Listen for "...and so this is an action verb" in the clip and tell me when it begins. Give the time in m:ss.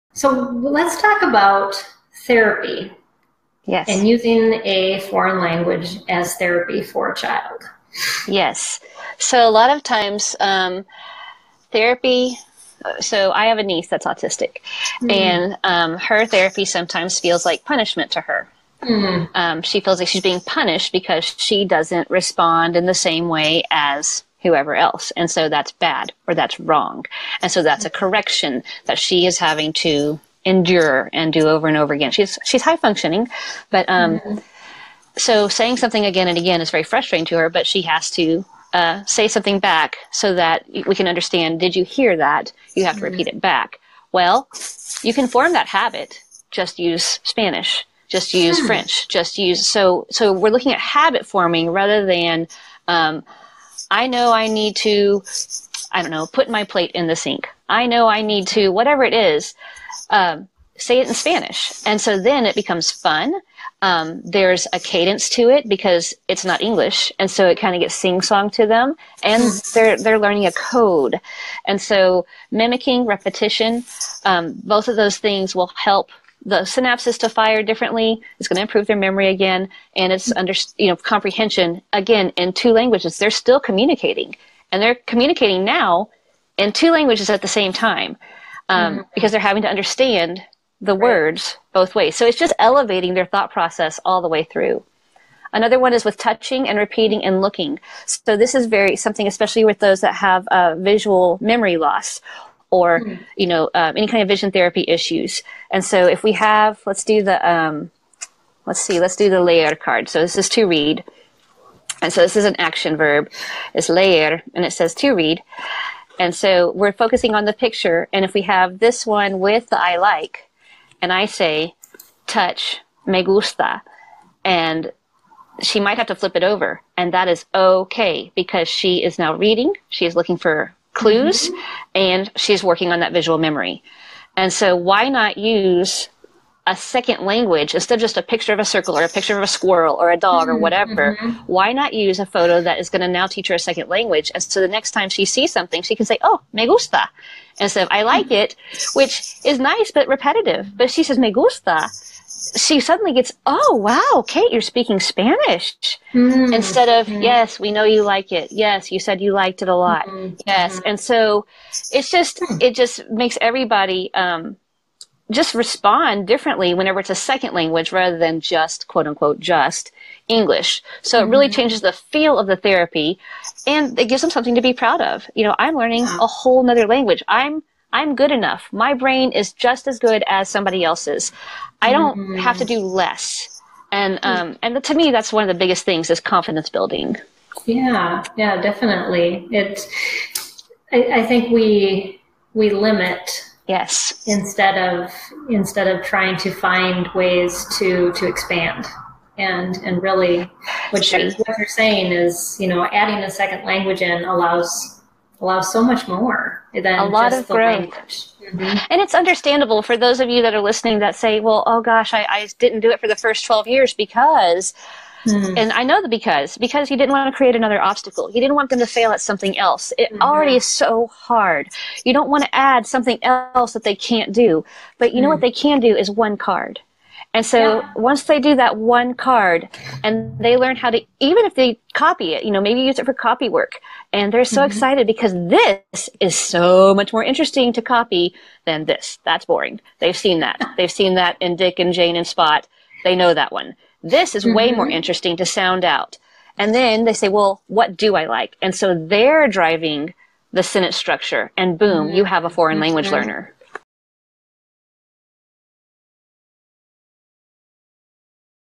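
1:52.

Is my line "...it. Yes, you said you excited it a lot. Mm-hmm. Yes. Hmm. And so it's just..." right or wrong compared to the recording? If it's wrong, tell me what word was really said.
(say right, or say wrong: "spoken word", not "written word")
wrong: "liked", not "excited".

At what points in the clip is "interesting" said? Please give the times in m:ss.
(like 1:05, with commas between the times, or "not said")
3:57, 4:04.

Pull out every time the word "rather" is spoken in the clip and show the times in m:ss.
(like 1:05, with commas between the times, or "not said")
0:51, 2:47.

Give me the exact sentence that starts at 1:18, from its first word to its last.
It's going to improve their memory again, and it's mm-hmm.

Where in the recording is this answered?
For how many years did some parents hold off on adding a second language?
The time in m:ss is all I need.
3:33.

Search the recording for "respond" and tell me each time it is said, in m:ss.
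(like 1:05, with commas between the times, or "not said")
0:22, 2:45.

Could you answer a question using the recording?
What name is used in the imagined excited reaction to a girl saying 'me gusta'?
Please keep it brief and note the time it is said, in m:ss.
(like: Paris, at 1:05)
Kate, at 2:34.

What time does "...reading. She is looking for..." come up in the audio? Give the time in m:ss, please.
2:09.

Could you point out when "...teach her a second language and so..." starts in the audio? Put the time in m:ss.
2:23.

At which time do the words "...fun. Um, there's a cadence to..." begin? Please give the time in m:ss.
1:02.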